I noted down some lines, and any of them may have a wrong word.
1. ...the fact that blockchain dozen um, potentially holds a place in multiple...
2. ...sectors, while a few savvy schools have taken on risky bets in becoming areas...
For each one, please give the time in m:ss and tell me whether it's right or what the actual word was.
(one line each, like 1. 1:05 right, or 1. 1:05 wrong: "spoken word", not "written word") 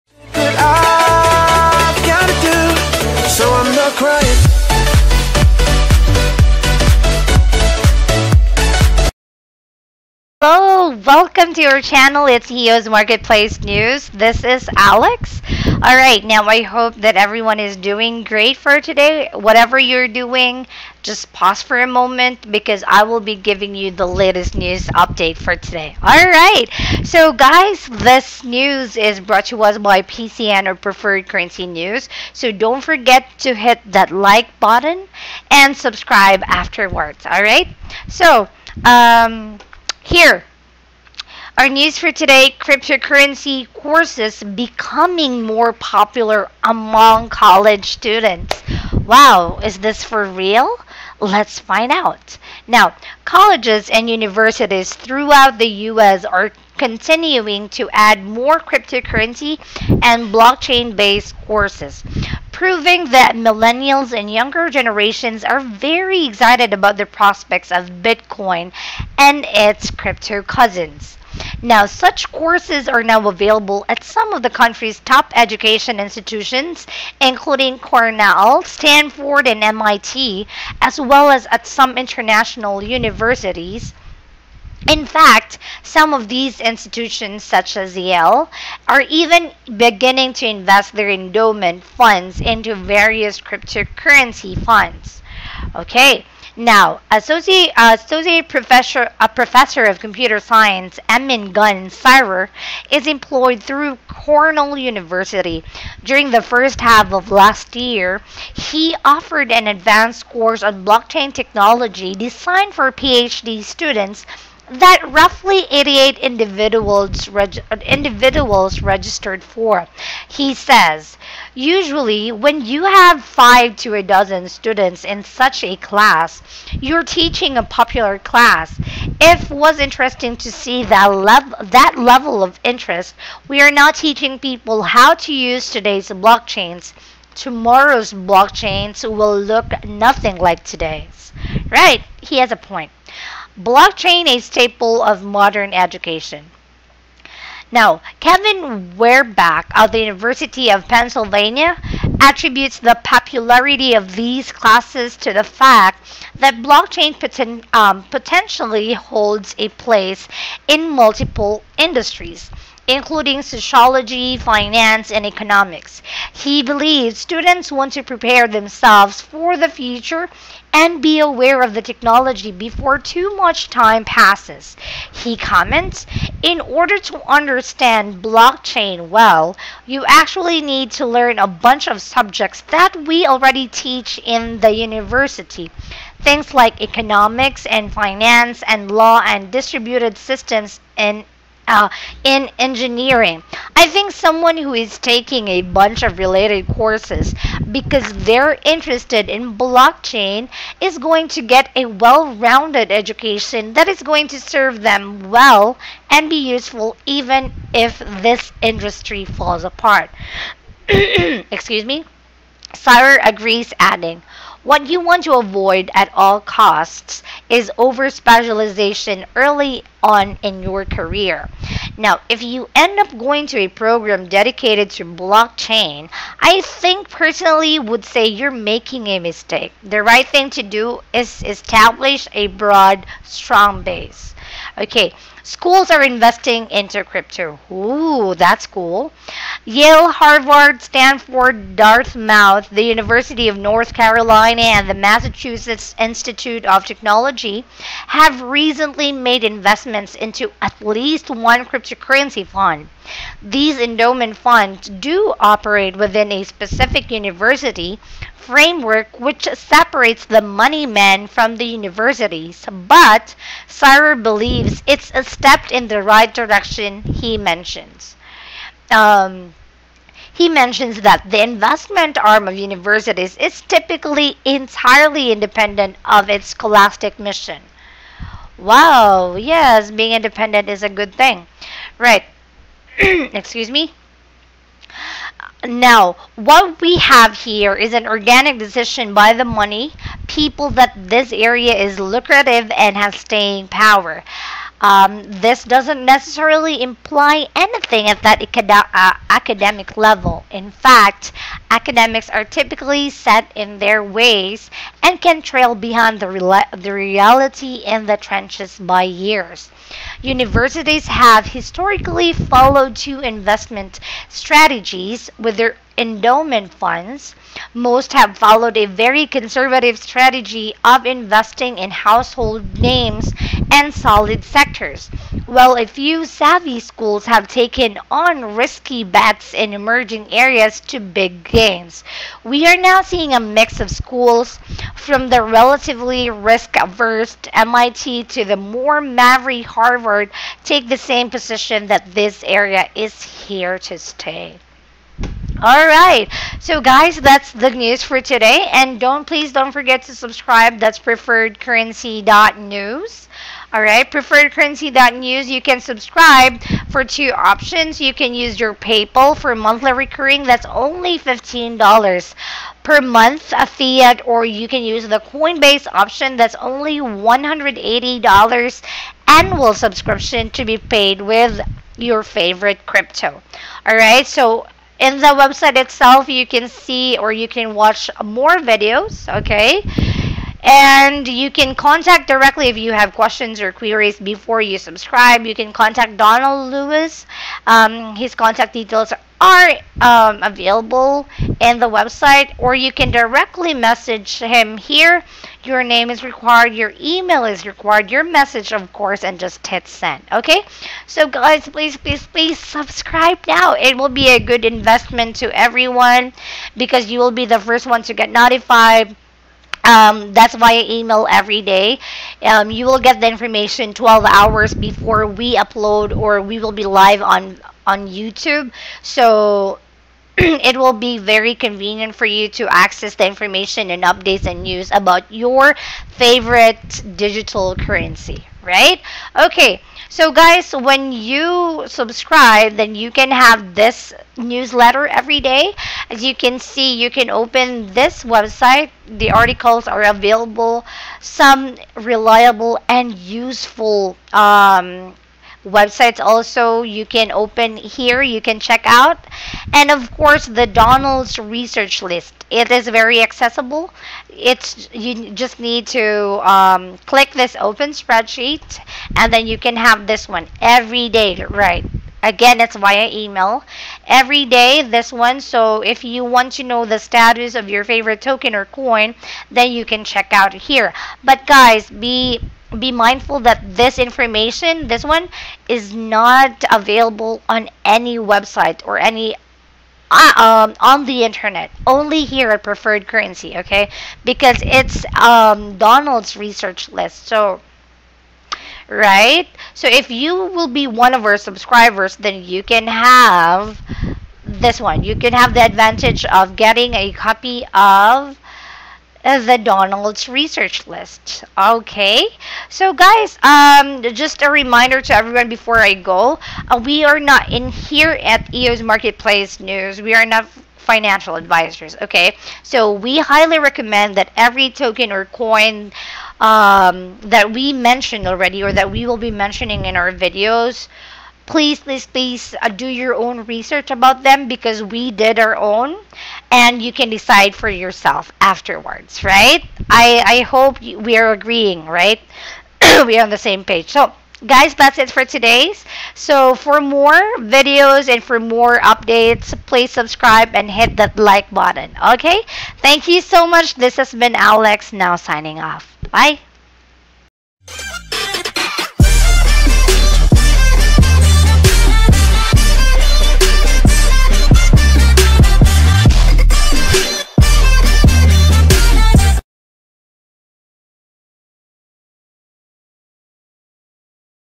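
1. 2:35 wrong: "poten", not "dozen"
2. 5:24 wrong: "emerging", not "becoming".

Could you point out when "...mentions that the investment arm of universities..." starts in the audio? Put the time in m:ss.
4:30.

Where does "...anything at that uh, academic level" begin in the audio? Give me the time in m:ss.
4:57.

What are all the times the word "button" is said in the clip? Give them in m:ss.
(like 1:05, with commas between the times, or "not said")
0:34, 9:01.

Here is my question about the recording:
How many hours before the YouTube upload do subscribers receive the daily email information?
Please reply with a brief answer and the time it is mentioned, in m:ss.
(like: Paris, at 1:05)
12, at 6:53.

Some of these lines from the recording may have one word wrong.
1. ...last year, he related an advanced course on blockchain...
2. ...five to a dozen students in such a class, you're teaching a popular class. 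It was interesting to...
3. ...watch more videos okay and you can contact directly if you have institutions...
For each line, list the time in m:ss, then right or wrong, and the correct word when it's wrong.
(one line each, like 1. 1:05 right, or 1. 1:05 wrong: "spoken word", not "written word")
1. 1:47 wrong: "offered", not "related"
2. 2:03 right
3. 6:17 wrong: "questions", not "institutions".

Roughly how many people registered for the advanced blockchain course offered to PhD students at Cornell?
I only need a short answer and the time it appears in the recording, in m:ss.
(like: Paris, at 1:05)
88, at 1:55.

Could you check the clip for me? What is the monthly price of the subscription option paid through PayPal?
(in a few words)
$15.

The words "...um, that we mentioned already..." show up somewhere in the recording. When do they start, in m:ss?
8:36.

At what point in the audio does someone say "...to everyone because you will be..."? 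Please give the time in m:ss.
6:45.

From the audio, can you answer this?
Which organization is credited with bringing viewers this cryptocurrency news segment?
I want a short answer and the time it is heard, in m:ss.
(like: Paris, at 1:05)
Preferred Currency News, at 0:30.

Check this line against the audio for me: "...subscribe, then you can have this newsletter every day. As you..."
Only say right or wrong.
right.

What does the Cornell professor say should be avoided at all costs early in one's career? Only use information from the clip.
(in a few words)
over specialization.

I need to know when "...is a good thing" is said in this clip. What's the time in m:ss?
4:40.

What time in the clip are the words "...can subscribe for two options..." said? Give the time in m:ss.
5:55.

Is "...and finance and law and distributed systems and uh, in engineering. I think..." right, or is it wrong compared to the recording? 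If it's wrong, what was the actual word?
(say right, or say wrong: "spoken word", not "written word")
right.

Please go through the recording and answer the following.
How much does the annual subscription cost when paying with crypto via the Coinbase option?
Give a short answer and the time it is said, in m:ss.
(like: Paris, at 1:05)
$180, at 6:06.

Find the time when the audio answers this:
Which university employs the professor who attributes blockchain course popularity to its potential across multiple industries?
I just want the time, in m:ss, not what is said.
2:29.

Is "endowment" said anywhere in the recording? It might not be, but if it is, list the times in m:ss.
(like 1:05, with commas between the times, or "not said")
1:31, 4:13, 5:15.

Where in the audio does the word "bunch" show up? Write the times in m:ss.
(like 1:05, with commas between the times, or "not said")
3:01, 3:15.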